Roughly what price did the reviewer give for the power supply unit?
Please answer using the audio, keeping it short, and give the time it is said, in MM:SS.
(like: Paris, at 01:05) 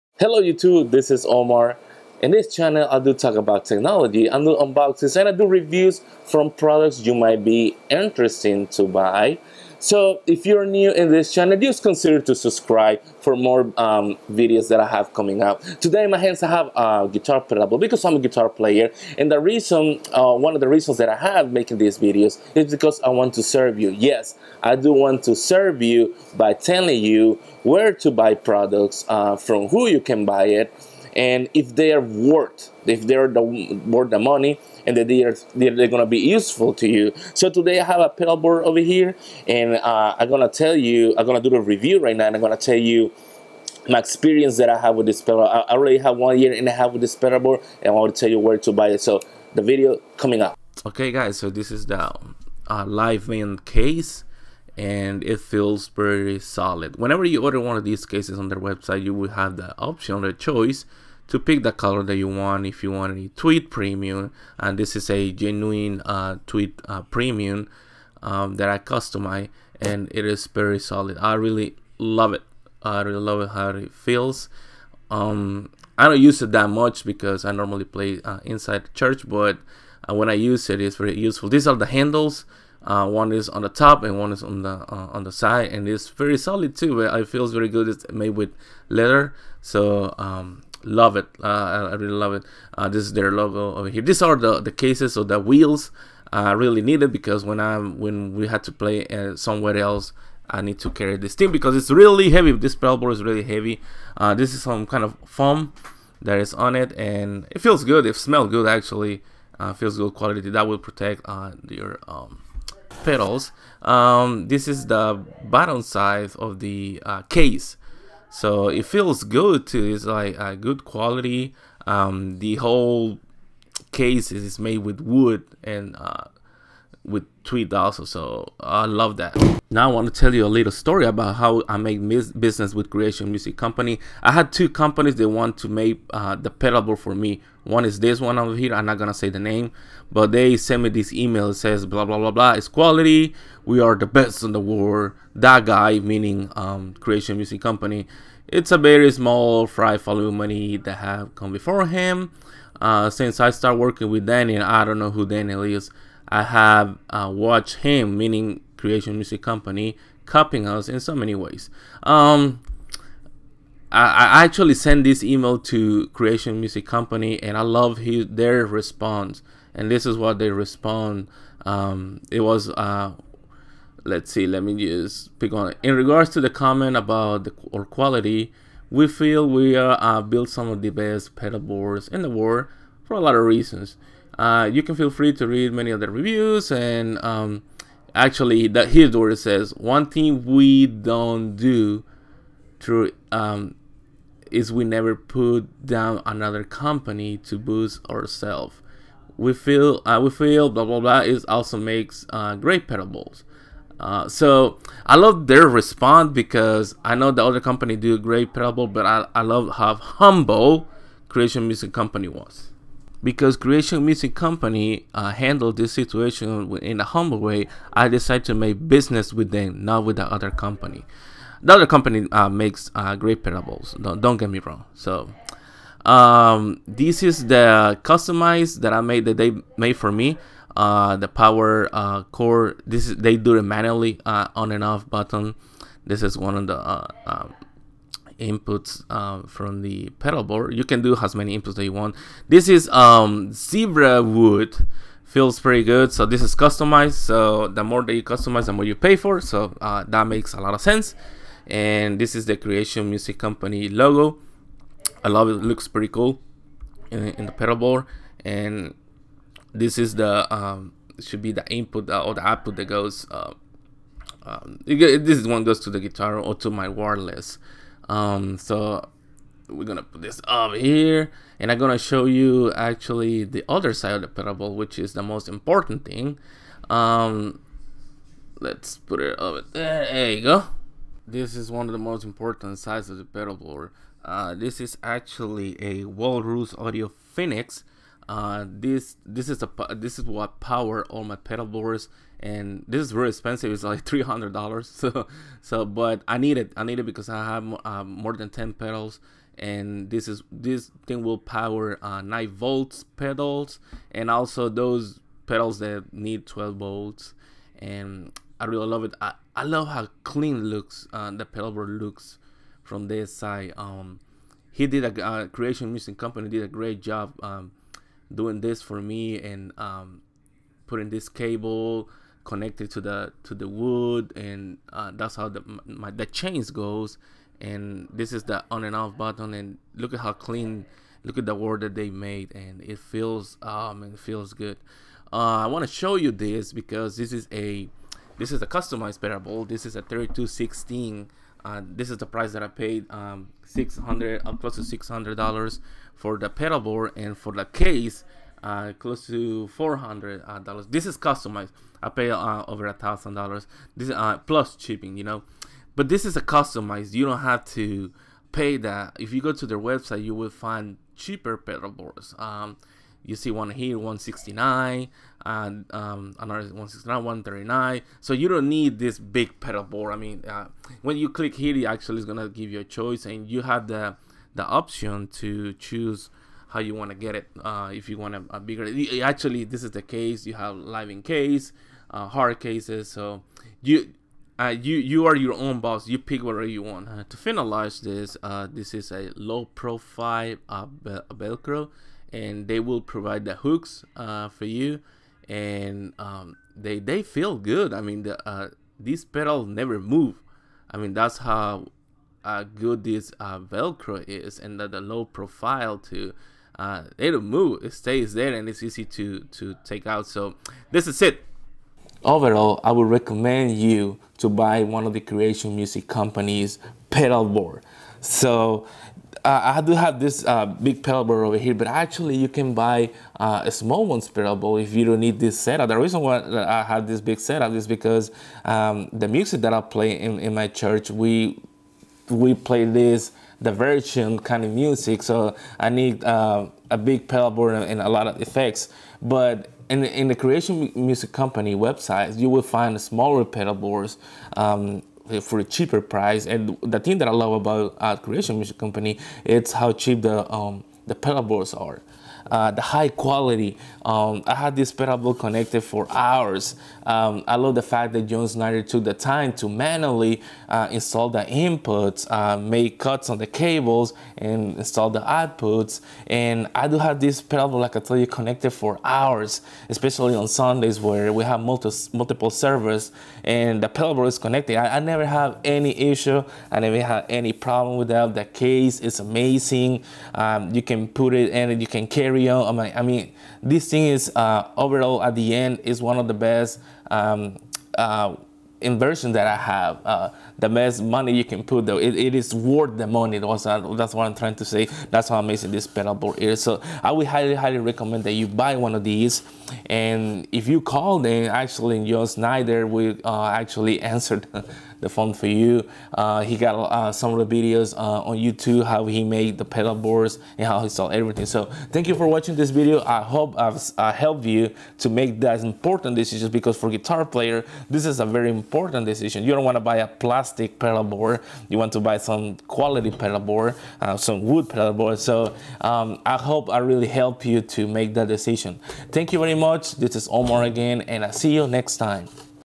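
$300, at 04:54.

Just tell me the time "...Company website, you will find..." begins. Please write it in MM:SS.
07:21.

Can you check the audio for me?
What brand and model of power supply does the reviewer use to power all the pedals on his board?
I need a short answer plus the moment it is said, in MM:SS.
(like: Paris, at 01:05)
Walrus Audio Phoenix, at 04:46.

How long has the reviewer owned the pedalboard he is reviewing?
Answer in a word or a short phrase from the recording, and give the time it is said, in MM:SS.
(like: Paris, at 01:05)
One year and a half, at 00:46.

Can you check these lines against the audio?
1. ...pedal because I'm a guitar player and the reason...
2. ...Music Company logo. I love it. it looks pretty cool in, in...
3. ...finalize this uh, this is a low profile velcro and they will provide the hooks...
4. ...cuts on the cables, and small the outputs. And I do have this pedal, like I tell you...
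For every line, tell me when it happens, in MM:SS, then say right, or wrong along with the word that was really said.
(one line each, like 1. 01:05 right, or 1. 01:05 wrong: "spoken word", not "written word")
1. 00:17 right
2. 04:13 right
3. 06:27 right
4. 07:42 wrong: "install", not "small".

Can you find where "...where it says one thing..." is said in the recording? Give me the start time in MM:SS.
03:09.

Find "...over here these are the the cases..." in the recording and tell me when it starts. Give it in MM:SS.
01:33.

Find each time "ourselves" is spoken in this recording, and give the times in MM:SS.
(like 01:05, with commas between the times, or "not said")
03:18.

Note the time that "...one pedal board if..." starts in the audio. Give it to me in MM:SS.
07:04.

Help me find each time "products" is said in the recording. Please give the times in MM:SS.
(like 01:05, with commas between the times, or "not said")
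00:06, 00:28.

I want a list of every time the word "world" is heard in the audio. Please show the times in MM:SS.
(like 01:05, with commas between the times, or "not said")
02:24, 03:02.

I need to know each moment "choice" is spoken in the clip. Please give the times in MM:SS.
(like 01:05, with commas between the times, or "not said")
01:00, 06:12.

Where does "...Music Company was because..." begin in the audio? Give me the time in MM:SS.
03:31.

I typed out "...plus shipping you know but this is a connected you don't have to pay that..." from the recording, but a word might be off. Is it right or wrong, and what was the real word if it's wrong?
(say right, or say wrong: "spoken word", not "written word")
wrong: "customized", not "connected".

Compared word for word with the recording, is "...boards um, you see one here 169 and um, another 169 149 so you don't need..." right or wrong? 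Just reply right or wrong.
wrong.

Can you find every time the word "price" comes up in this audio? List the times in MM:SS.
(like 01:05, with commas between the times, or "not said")
05:42, 07:26.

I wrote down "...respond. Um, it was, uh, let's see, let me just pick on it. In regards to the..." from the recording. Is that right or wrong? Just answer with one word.
right.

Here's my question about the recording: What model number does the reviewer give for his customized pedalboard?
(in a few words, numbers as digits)
3216.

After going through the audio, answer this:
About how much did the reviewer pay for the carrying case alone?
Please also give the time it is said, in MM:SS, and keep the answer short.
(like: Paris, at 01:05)
$400, at 05:48.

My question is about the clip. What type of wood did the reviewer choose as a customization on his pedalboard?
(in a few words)
Zebra wood.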